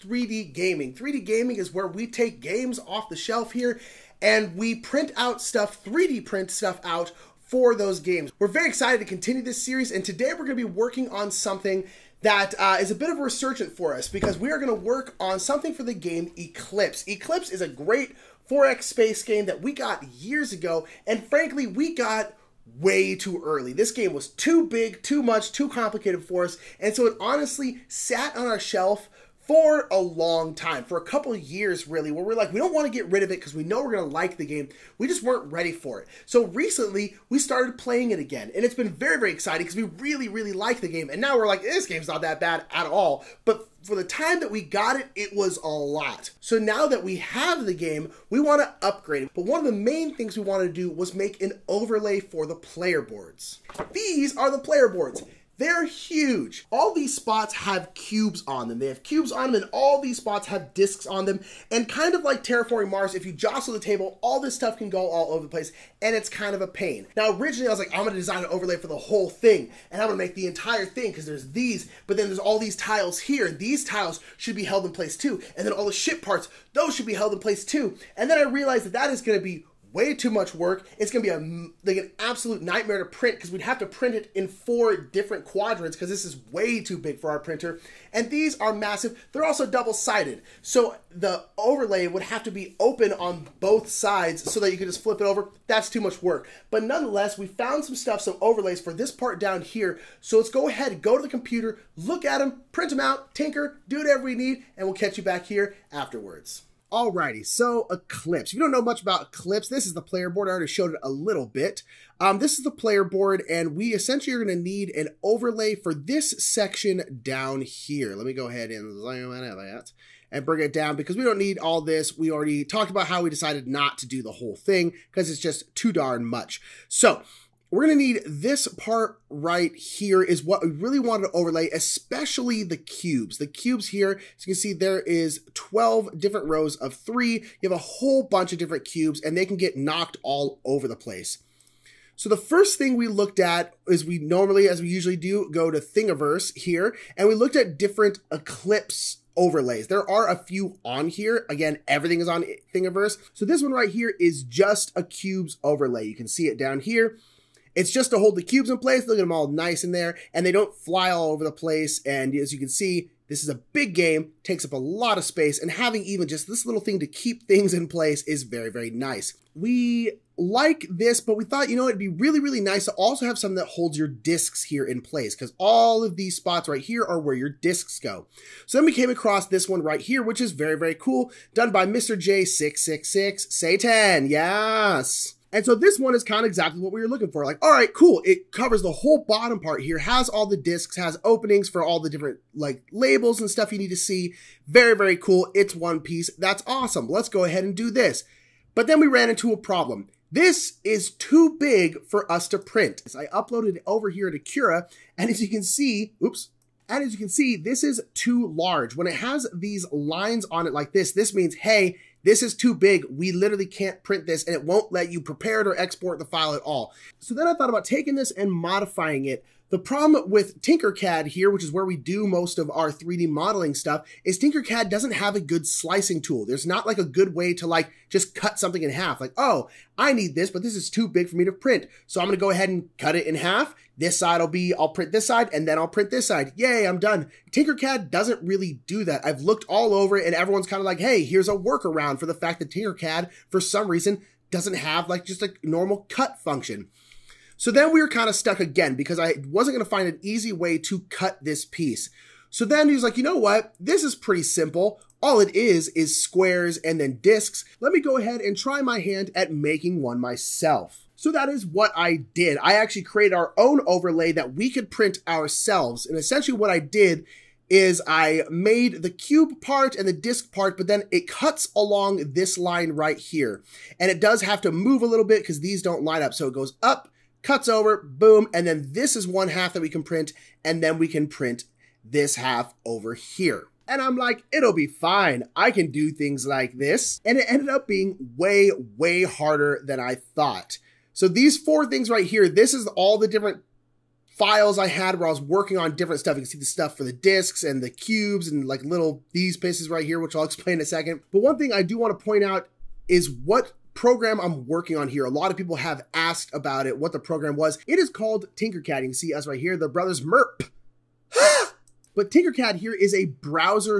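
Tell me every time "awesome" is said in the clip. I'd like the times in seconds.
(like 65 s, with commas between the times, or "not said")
196 s.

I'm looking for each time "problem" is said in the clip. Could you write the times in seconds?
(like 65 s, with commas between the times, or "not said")
199 s, 219 s.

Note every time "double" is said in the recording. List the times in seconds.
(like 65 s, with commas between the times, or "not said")
89 s.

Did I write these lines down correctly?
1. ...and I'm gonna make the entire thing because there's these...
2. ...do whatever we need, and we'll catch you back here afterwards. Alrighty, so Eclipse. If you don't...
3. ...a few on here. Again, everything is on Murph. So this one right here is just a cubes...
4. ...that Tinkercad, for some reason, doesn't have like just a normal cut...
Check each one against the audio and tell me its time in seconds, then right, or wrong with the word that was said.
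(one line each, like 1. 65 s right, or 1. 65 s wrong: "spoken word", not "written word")
1. 69 s right
2. 103 s right
3. 150 s wrong: "Thingiverse", not "Murph"
4. 242 s right.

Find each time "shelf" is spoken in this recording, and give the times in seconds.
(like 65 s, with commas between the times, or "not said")
3 s, 28 s.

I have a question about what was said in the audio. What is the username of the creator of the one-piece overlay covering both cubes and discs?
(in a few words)
Mr. J666.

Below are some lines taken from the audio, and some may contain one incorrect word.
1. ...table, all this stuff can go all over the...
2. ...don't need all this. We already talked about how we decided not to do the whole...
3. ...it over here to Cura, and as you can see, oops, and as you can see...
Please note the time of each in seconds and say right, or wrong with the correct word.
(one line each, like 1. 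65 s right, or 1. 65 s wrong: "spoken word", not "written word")
1. 63 s right
2. 121 s right
3. 203 s right.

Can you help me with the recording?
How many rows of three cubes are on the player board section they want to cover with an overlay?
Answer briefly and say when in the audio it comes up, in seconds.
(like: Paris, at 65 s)
12, at 135 s.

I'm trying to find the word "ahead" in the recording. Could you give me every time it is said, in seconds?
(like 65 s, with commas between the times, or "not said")
100 s, 118 s, 197 s, 232 s, 258 s.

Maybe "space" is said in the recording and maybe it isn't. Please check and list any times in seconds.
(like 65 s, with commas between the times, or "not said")
18 s, 165 s.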